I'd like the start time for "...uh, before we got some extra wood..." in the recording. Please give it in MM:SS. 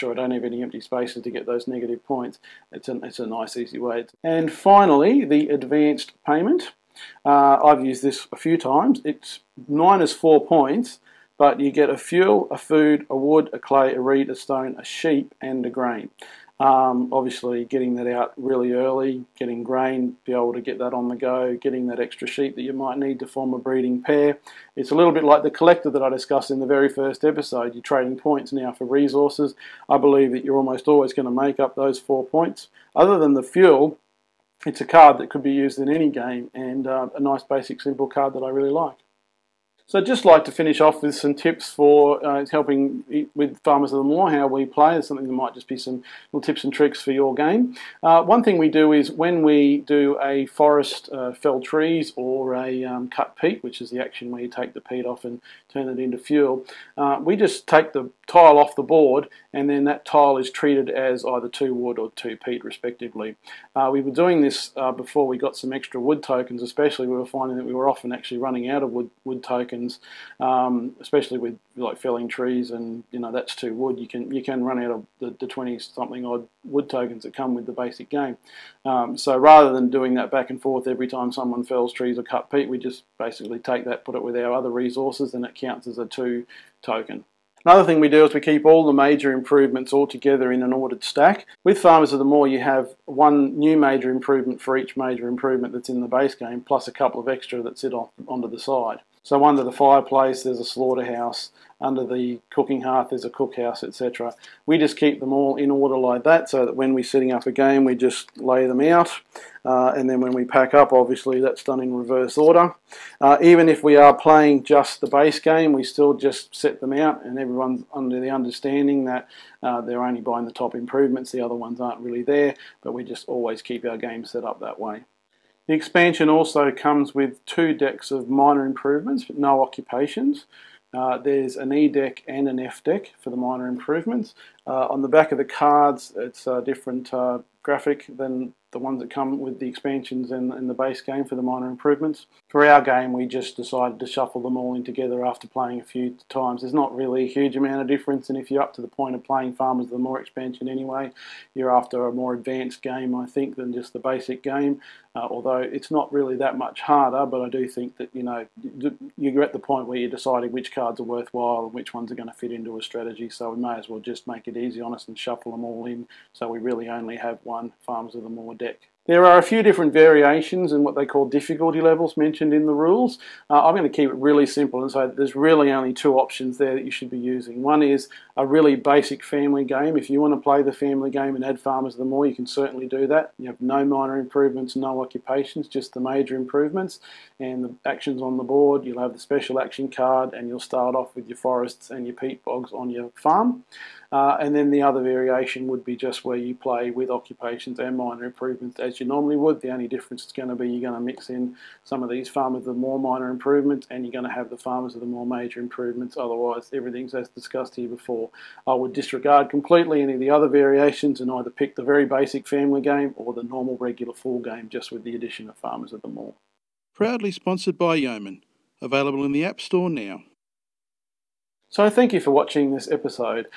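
01:04.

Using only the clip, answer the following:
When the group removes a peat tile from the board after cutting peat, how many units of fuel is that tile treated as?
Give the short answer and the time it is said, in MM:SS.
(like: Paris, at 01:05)
2, at 01:01.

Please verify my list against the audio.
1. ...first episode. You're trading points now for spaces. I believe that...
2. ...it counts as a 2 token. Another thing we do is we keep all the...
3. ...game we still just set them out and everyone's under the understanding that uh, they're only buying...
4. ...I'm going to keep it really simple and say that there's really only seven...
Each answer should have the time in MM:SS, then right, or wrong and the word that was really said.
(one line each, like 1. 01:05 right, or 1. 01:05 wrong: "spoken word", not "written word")
1. 00:26 wrong: "resources", not "spaces"
2. 01:25 right
3. 01:55 right
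4. 02:53 wrong: "two", not "seven".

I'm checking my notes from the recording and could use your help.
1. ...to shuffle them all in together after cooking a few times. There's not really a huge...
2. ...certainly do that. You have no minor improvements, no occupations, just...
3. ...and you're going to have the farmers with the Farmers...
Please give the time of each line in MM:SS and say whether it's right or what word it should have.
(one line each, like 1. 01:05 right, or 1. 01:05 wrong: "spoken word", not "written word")
1. 02:23 wrong: "playing", not "cooking"
2. 03:02 right
3. 03:23 wrong: "Moor", not "Farmers".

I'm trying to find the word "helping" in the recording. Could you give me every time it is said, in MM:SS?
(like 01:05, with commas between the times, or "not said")
00:42.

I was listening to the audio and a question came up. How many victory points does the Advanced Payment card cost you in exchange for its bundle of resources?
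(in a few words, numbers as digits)
4.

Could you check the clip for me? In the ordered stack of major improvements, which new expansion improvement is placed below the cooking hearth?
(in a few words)
cookhouse.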